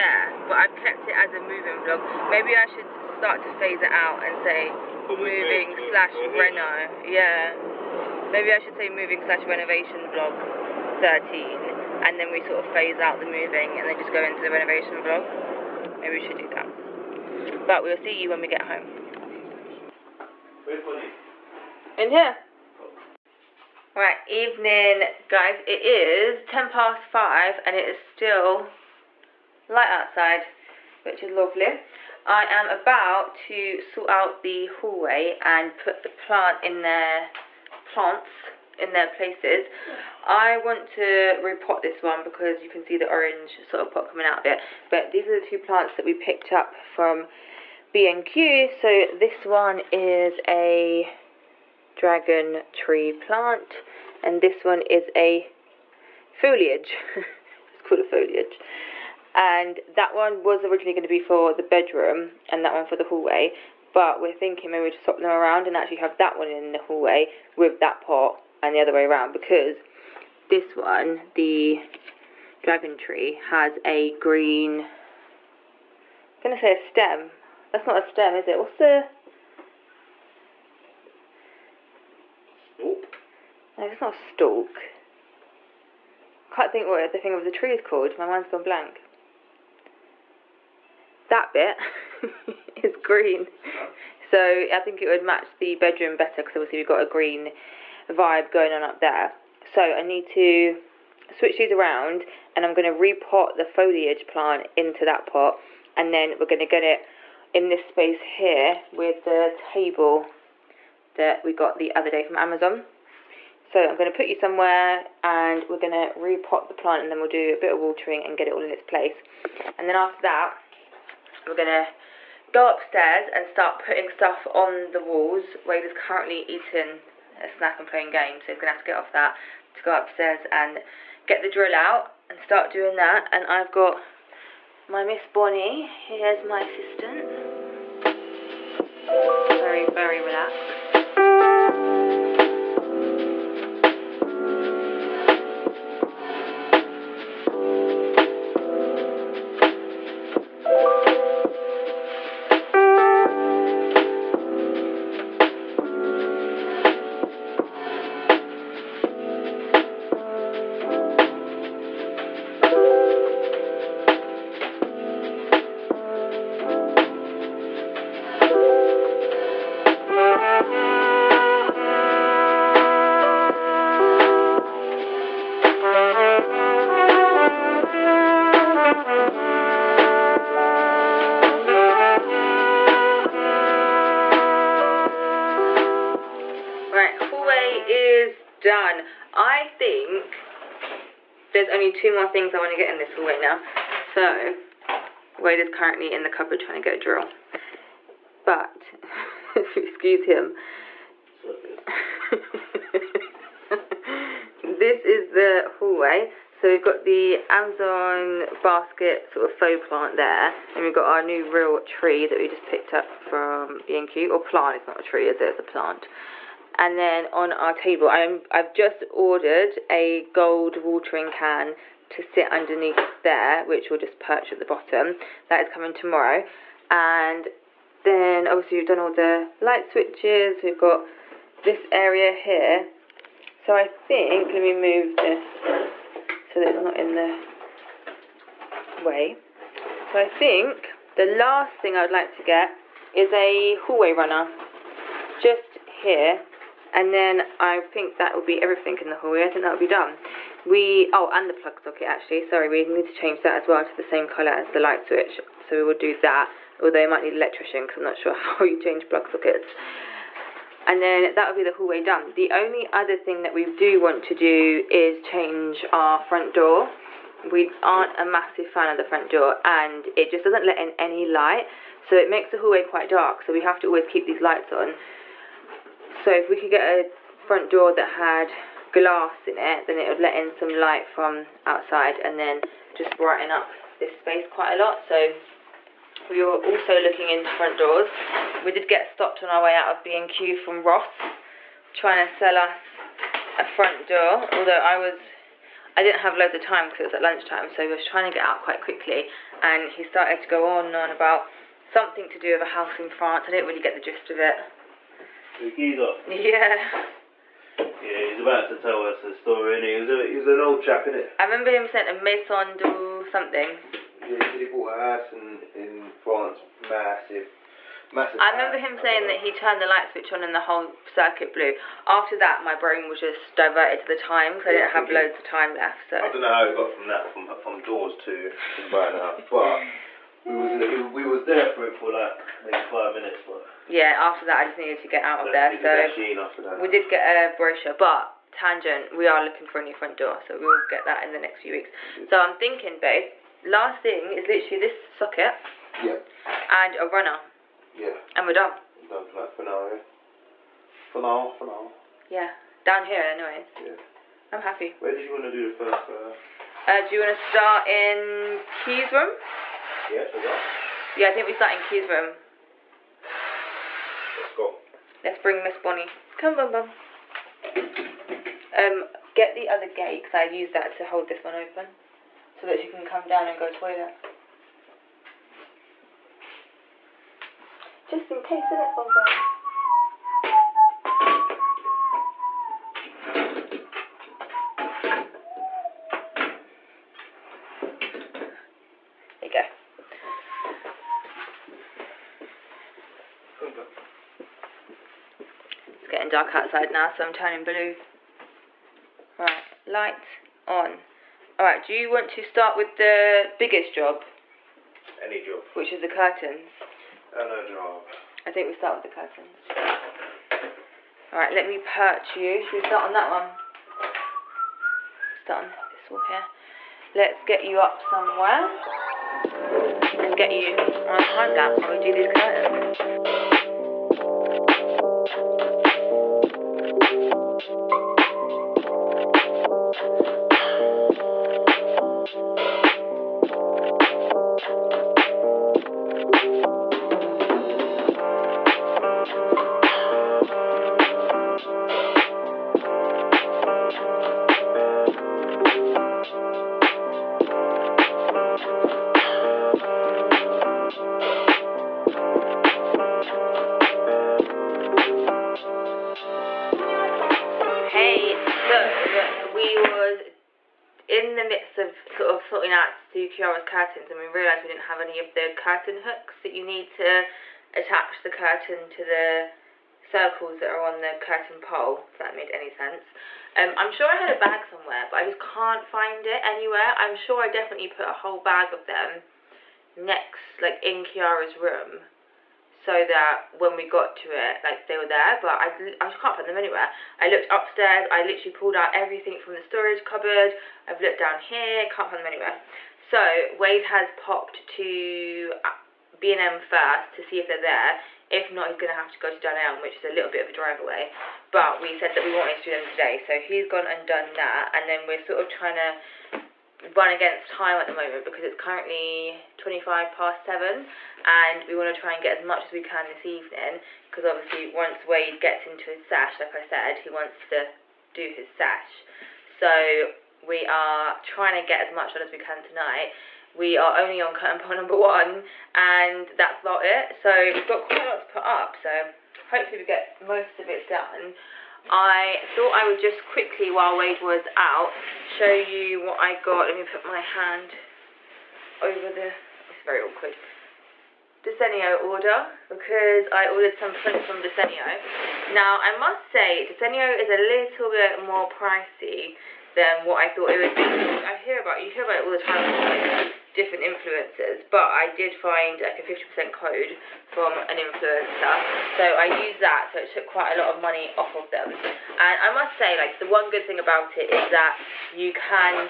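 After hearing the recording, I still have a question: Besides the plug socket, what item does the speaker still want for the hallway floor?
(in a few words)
A hallway runner.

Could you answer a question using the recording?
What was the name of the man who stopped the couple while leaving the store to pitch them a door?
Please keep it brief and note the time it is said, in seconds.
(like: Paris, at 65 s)
Ross, at 290 s.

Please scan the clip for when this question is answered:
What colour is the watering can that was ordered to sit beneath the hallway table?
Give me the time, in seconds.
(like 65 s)
220 s.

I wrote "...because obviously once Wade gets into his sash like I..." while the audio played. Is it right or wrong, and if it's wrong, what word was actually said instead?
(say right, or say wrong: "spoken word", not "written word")
right.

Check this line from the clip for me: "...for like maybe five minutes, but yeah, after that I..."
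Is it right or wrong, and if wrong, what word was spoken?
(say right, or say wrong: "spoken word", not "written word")
right.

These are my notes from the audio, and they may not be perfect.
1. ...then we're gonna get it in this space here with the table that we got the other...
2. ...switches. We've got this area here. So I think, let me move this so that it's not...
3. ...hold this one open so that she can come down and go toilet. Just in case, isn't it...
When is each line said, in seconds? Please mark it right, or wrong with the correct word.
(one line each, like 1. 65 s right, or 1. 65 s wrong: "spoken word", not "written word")
1. 106 s right
2. 229 s right
3. 371 s right.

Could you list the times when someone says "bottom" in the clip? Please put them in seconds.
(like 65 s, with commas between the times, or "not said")
224 s.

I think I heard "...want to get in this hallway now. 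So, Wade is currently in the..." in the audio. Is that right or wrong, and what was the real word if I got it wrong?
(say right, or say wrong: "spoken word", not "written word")
right.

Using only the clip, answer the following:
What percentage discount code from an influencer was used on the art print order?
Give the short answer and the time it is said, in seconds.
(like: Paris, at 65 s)
50%, at 556 s.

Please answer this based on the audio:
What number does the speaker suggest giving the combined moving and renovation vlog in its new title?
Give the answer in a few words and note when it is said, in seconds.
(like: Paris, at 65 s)
13, at 11 s.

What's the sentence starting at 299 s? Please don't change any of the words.
And he started to go on and on about something to do with a house in France.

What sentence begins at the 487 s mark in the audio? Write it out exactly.
I looked upstairs, I literally pulled out everything from the storage cupboard, I've looked down here, can't find them anywhere.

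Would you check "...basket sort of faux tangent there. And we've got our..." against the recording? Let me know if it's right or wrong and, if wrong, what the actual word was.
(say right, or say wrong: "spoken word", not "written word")
wrong: "plant", not "tangent".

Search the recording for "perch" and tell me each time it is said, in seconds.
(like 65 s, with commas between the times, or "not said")
224 s, 411 s.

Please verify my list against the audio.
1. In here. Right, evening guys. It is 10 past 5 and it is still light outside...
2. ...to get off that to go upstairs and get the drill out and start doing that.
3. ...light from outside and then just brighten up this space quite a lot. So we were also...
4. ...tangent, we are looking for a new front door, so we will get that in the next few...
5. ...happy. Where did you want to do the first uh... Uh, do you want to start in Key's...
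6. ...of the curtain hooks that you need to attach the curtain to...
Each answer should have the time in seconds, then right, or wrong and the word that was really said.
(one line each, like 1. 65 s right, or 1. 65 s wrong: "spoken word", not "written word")
1. 21 s right
2. 128 s right
3. 280 s right
4. 338 s right
5. 354 s right
6. 465 s right.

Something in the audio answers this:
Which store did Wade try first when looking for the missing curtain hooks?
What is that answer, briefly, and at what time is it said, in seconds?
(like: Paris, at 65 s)
B&M, at 496 s.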